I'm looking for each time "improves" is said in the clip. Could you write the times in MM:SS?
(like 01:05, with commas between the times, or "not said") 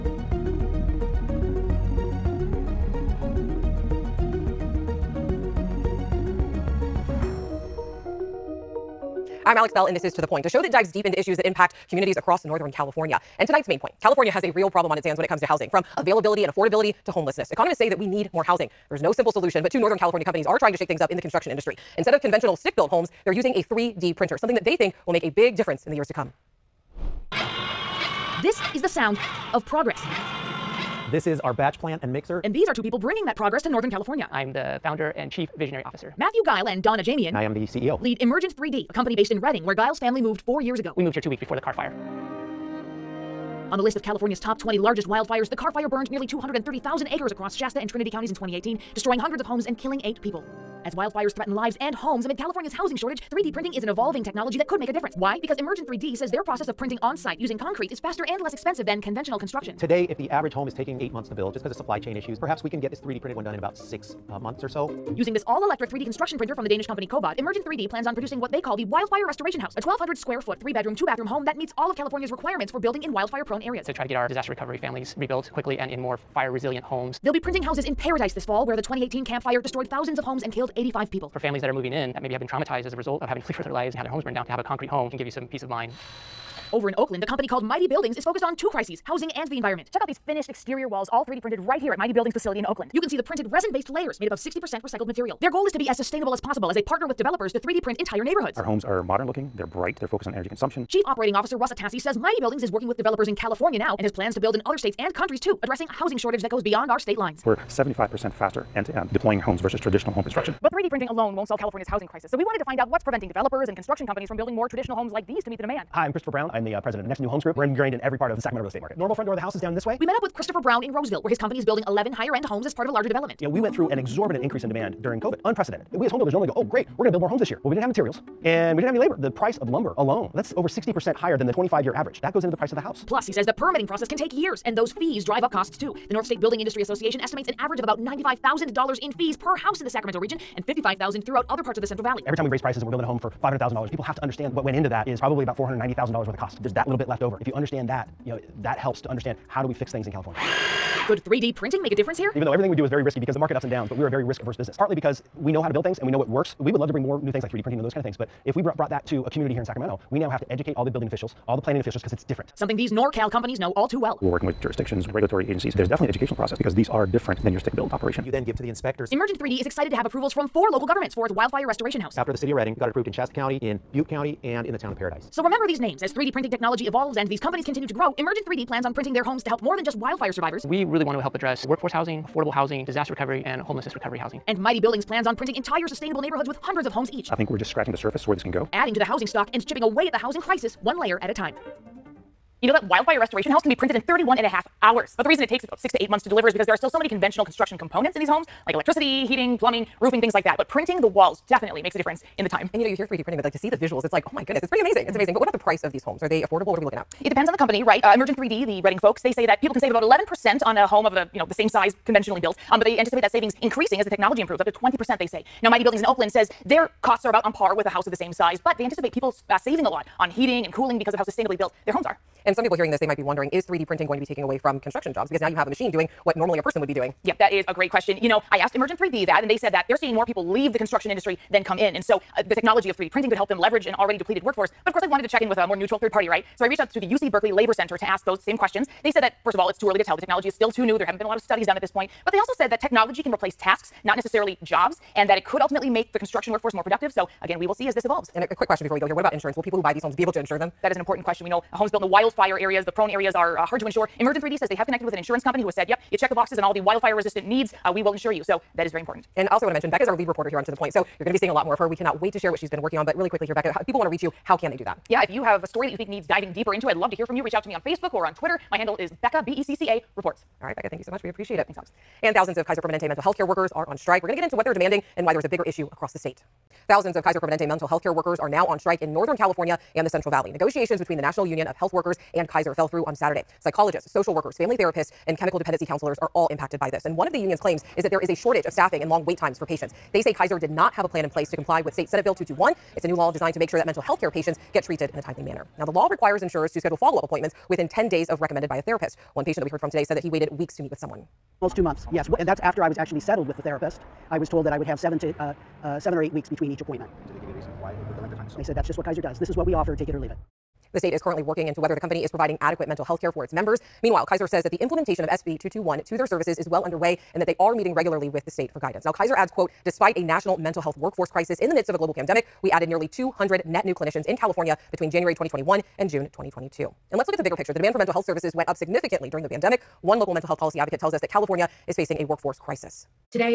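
03:34.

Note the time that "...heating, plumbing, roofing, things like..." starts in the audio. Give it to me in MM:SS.
03:19.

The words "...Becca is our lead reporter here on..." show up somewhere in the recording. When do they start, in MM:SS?
04:19.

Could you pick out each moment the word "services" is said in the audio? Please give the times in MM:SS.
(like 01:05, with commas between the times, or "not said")
05:16, 05:28.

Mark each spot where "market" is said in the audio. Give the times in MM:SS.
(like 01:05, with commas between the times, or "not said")
01:58, 02:33.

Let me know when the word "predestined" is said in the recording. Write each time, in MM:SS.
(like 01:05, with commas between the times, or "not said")
not said.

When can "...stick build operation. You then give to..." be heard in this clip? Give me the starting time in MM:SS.
02:47.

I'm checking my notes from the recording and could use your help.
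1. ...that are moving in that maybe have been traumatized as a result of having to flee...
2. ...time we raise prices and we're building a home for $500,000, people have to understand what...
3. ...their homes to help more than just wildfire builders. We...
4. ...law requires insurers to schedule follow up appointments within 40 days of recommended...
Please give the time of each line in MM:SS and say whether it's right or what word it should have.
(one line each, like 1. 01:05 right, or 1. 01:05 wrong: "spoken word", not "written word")
1. 01:21 right
2. 02:22 right
3. 02:59 wrong: "survivors", not "builders"
4. 04:55 wrong: "10", not "40".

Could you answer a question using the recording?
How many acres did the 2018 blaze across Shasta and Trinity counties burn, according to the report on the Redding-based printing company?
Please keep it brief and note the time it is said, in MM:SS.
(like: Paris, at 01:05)
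230,000, at 00:46.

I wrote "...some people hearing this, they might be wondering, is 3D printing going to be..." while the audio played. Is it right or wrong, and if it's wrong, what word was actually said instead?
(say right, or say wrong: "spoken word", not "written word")
right.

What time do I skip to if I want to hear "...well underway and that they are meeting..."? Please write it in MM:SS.
05:16.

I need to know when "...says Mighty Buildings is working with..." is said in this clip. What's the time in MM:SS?
01:41.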